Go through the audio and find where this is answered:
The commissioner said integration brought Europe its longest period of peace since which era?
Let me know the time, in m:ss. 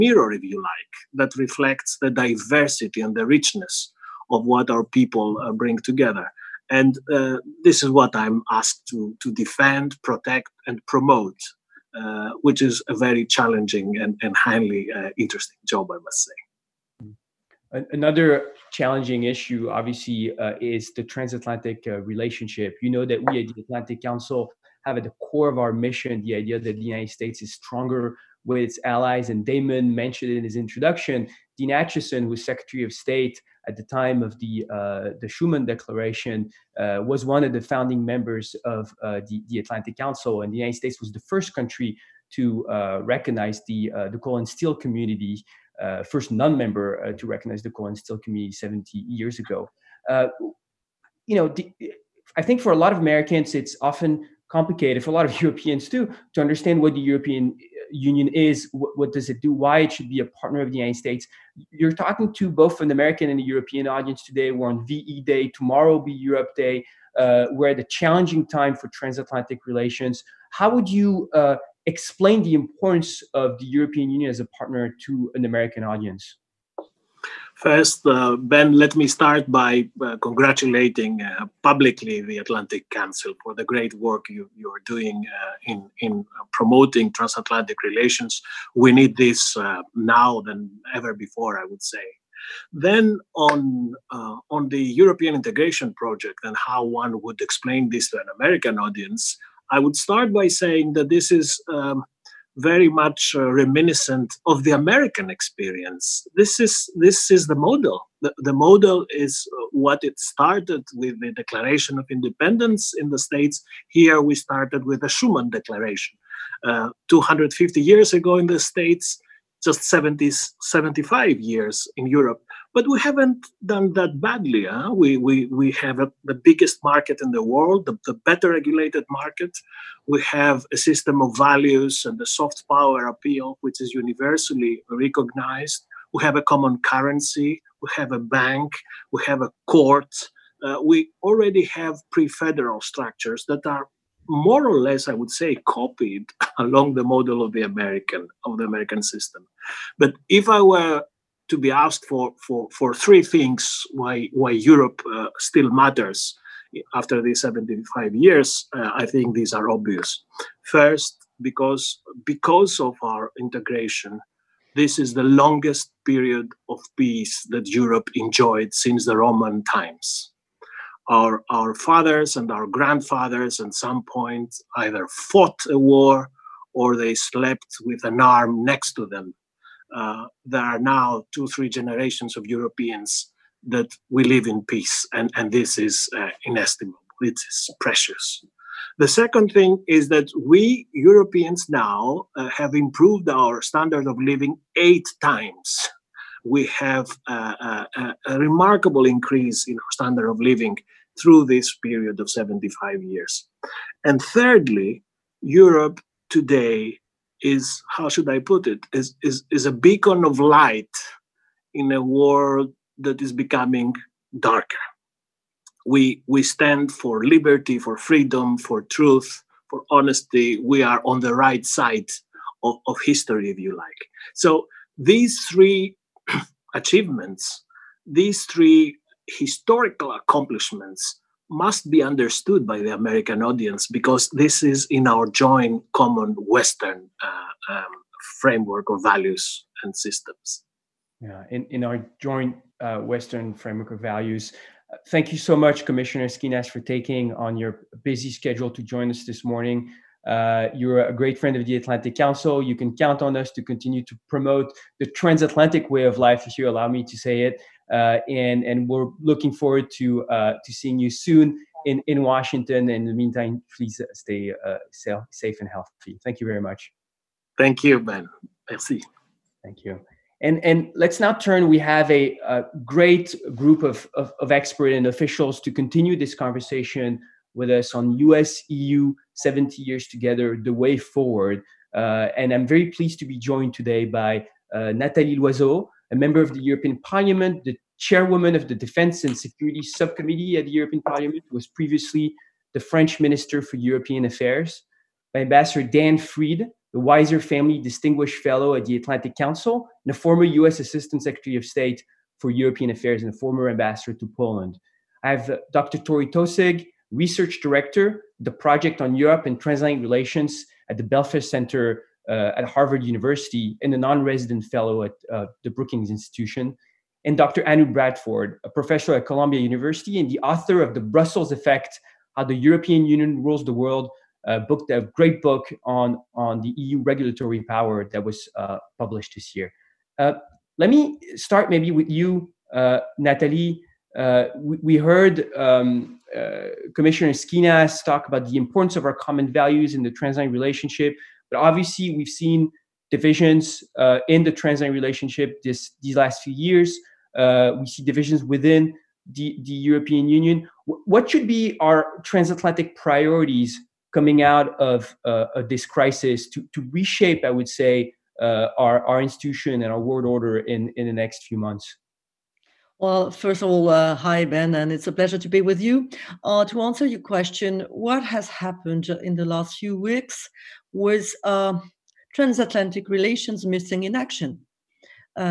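2:49.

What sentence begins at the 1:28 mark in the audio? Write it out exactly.
We need this uh, now than ever before, I would say.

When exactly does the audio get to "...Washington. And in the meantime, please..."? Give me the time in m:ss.
4:22.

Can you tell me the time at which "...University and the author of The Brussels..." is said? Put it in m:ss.
5:19.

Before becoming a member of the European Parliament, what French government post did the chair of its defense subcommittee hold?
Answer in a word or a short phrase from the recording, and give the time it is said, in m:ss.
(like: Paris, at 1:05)
Minister for European Affairs, at 4:53.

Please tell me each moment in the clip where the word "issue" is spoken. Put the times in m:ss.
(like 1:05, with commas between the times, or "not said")
0:19.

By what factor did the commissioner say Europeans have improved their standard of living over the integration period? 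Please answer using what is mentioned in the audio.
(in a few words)
8 times.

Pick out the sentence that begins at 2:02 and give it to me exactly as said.
But we haven't done that badly.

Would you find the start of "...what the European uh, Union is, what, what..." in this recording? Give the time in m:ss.
0:56.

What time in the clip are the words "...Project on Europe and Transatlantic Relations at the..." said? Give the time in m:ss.
5:08.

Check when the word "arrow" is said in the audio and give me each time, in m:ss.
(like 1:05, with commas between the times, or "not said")
not said.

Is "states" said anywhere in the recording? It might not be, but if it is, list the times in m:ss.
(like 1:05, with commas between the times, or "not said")
0:27, 0:32, 0:40, 1:00, 1:53, 1:58, 5:01.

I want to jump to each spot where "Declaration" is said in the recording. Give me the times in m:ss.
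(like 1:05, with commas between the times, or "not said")
0:35, 1:51, 1:55.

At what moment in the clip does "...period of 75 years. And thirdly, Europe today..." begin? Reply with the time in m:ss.
3:21.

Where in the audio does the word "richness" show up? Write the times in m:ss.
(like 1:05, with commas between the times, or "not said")
0:03.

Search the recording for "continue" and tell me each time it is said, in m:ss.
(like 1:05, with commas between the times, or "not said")
4:13, 4:35.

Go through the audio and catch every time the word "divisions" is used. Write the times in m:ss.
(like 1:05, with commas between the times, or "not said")
5:43, 5:48.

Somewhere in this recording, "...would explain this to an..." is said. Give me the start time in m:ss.
1:37.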